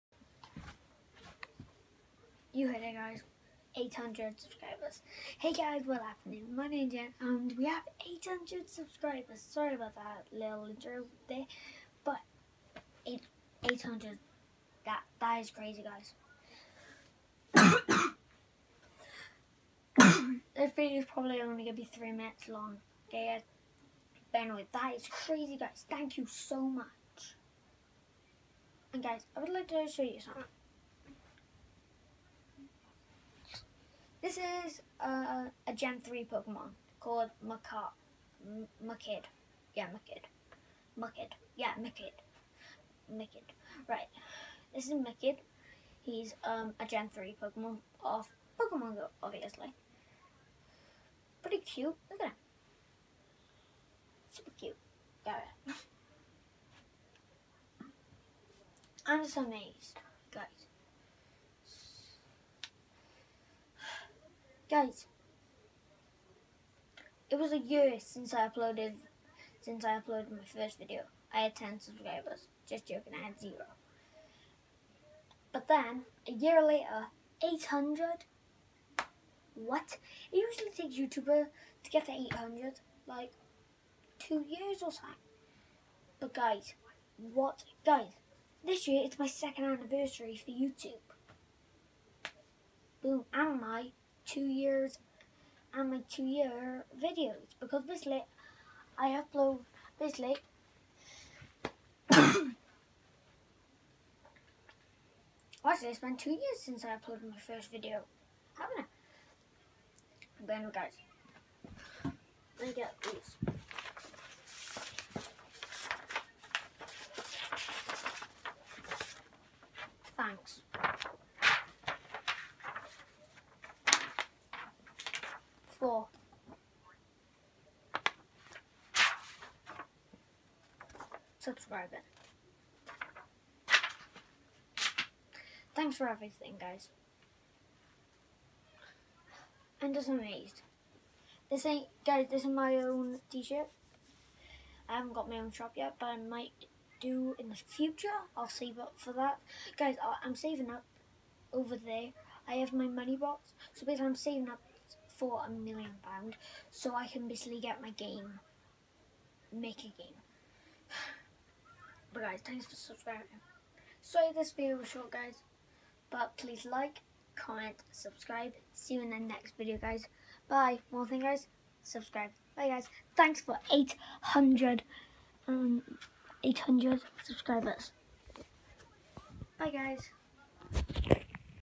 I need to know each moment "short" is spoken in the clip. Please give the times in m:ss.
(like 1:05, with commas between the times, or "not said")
2:44.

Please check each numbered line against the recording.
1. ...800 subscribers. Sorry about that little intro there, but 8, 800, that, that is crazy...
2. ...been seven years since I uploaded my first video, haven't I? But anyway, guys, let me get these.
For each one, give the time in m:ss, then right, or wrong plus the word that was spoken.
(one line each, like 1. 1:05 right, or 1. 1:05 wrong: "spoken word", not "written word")
1. 0:08 right
2. 1:45 wrong: "two", not "seven".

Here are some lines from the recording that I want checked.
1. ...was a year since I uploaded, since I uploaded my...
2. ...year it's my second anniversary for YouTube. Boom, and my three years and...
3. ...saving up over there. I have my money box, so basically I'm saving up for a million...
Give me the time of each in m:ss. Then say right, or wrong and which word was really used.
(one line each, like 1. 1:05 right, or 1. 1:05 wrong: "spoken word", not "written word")
1. 1:07 right
2. 1:28 wrong: "two", not "three"
3. 2:30 right.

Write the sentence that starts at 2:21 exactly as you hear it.
This ain't, guys, this is my own t-shirt.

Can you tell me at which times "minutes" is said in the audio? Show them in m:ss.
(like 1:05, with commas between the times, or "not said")
0:22.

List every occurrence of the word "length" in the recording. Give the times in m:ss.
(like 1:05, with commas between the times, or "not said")
not said.